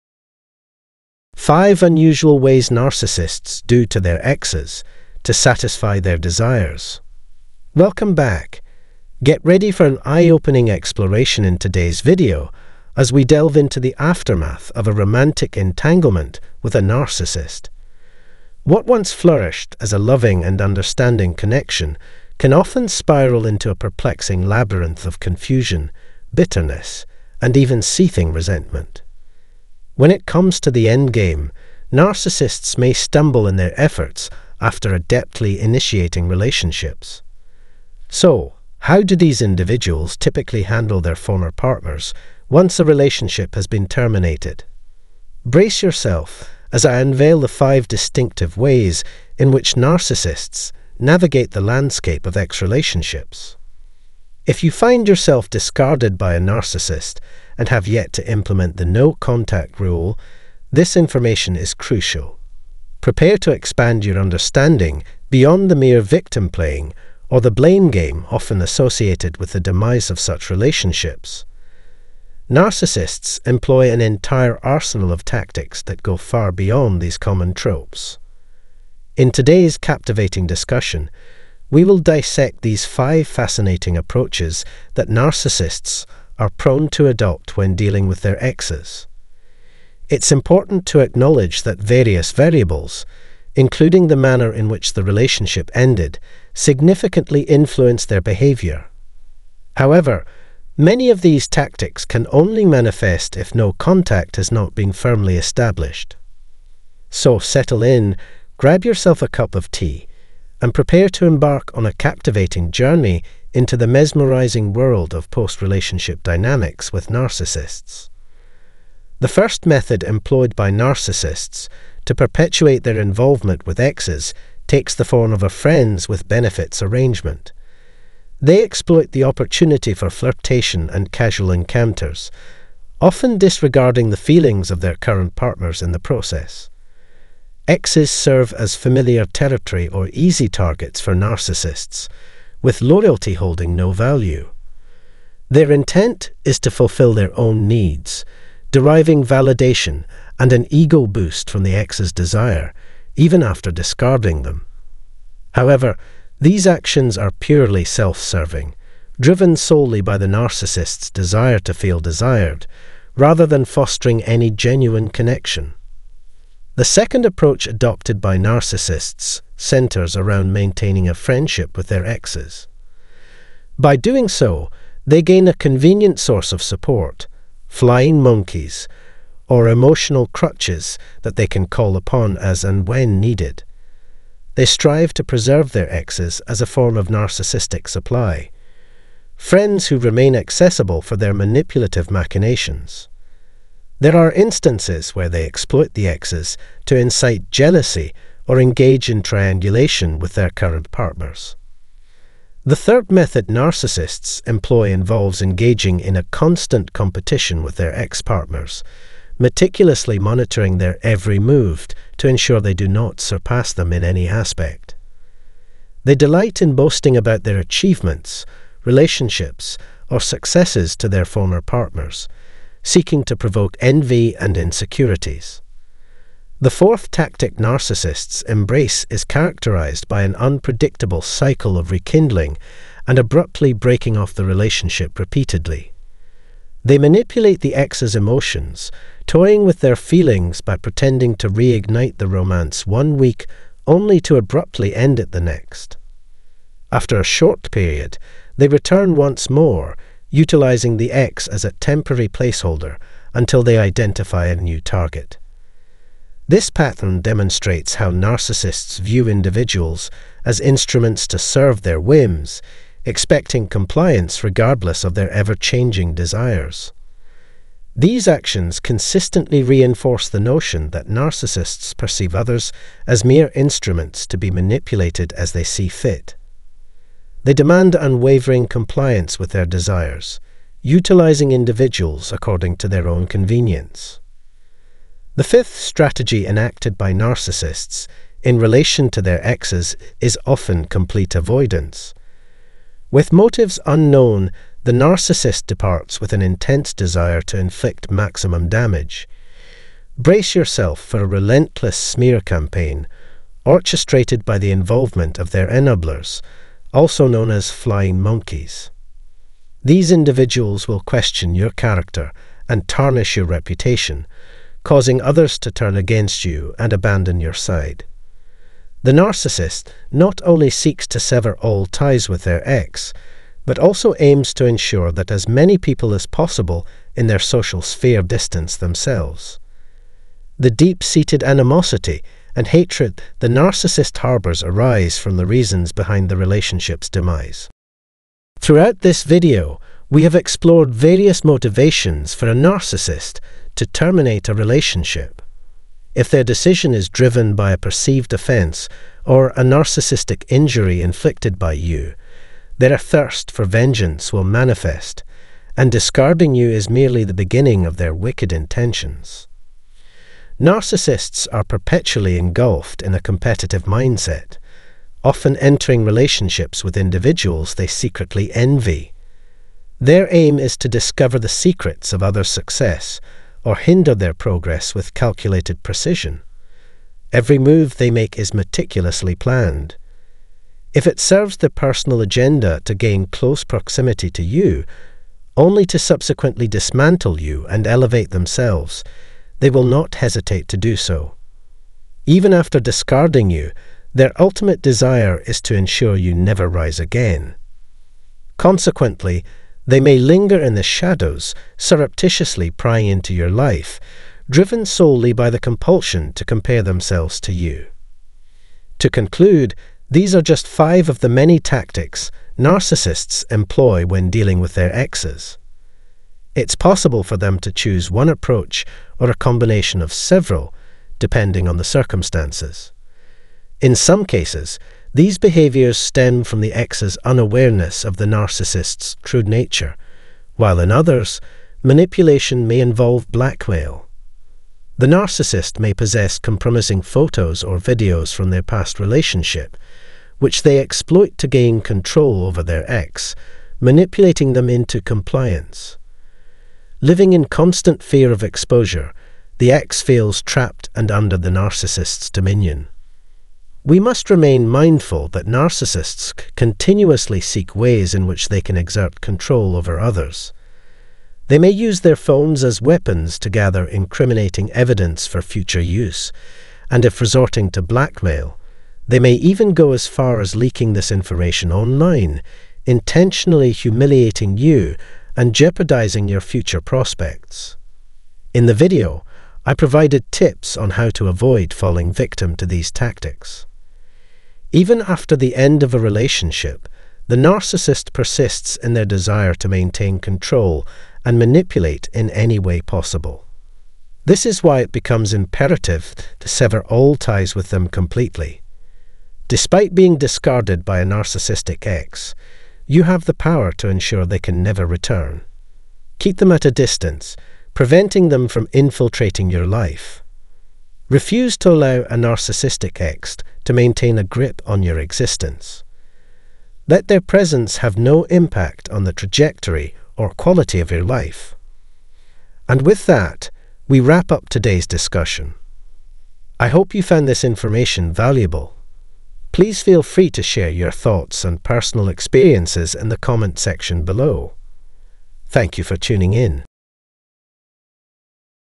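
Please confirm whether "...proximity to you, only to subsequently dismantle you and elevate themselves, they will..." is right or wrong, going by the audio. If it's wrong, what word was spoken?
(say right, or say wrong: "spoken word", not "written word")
right.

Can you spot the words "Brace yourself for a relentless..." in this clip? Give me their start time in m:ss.
5:00.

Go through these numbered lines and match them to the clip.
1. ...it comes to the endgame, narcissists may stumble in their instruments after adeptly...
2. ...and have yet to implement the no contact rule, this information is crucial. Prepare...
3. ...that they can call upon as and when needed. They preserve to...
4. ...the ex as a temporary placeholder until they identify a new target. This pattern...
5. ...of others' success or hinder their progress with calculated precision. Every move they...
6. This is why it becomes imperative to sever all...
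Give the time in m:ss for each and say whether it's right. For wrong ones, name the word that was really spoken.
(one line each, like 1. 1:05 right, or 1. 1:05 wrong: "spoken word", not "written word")
1. 0:30 wrong: "efforts", not "instruments"
2. 0:57 right
3. 3:01 wrong: "strive", not "preserve"
4. 4:10 right
5. 6:12 right
6. 8:14 right.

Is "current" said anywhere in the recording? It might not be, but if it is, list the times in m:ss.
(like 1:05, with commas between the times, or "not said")
2:14, 3:20.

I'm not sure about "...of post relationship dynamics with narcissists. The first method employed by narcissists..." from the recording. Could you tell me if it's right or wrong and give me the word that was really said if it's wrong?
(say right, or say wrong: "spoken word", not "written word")
right.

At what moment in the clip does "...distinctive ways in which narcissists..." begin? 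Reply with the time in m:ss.
0:47.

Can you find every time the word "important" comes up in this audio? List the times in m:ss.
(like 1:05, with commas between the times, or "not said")
1:30.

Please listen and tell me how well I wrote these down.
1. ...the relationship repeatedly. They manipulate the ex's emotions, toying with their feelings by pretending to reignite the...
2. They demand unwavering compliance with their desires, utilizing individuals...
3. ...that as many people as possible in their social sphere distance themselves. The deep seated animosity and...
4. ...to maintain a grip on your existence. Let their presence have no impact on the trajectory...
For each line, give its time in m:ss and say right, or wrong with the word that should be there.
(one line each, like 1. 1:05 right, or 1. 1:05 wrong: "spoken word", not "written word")
1. 3:54 right
2. 4:37 right
3. 5:25 right
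4. 8:33 right.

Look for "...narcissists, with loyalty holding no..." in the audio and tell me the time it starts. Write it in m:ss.
2:21.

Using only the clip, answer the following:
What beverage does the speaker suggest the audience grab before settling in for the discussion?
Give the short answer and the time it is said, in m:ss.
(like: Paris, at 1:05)
tea, at 1:49.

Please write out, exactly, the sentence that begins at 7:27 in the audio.
Living in constant fear of exposure, the ex feels trapped and under the narcissist's dominion.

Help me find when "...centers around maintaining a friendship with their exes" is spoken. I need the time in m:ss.
2:49.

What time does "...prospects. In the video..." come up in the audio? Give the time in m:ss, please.
7:56.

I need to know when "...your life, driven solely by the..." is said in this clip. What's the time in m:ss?
6:43.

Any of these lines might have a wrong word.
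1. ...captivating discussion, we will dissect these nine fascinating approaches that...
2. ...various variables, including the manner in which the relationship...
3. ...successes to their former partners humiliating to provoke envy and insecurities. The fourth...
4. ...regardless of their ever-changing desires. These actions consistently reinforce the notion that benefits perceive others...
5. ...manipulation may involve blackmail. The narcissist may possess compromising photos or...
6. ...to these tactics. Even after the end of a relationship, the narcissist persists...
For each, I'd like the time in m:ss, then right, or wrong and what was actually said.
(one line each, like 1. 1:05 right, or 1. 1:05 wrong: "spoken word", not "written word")
1. 1:19 wrong: "five", not "nine"
2. 1:31 right
3. 3:40 wrong: "seeking", not "humiliating"
4. 4:24 wrong: "narcissists", not "benefits"
5. 7:11 right
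6. 8:02 right.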